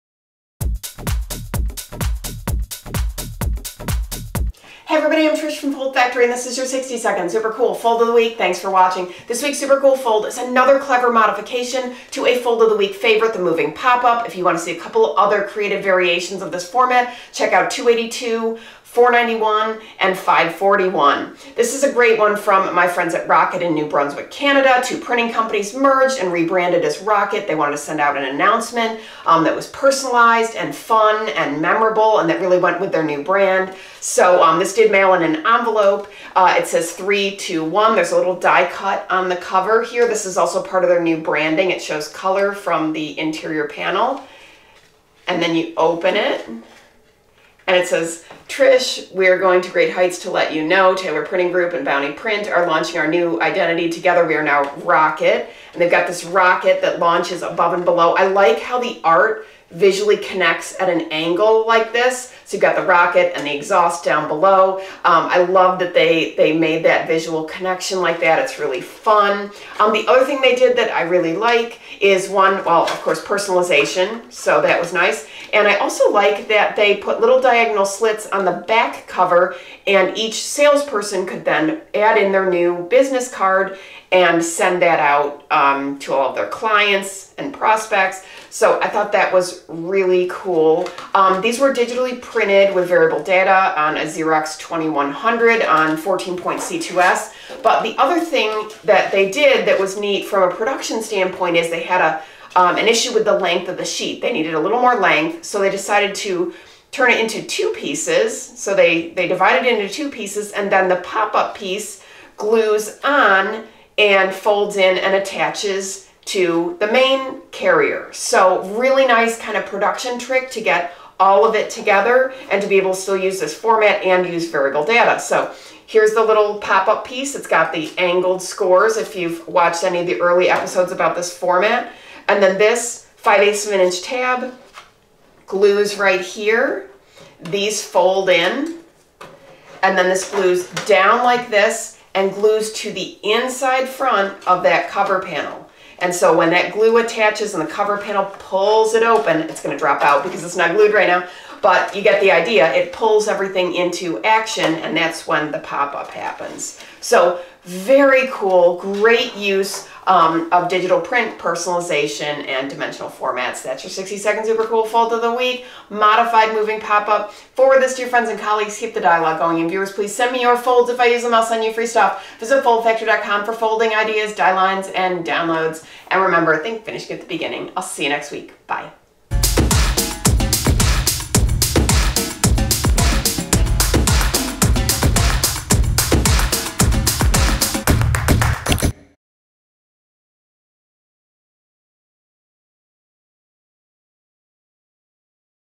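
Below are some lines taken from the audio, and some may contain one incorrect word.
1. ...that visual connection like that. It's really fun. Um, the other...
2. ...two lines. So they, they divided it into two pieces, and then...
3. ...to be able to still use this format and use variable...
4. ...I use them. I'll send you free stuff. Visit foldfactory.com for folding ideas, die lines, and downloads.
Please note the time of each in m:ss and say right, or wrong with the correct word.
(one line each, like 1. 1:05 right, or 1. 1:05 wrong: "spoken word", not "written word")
1. 1:06 right
2. 1:47 wrong: "pieces", not "lines"
3. 2:02 right
4. 2:50 right.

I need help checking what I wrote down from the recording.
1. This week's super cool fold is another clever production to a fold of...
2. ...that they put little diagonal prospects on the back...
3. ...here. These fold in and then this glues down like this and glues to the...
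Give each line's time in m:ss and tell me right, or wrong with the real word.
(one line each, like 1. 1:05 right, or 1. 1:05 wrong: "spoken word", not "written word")
1. 0:09 wrong: "modification", not "production"
2. 1:16 wrong: "slits", not "prospects"
3. 2:16 right.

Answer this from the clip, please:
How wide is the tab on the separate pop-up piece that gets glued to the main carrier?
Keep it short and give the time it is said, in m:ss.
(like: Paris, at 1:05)
5/8 of an inch, at 2:13.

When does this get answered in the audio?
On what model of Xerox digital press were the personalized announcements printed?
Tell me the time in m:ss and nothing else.
1:34.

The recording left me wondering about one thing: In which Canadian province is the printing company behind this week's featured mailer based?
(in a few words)
New Brunswick.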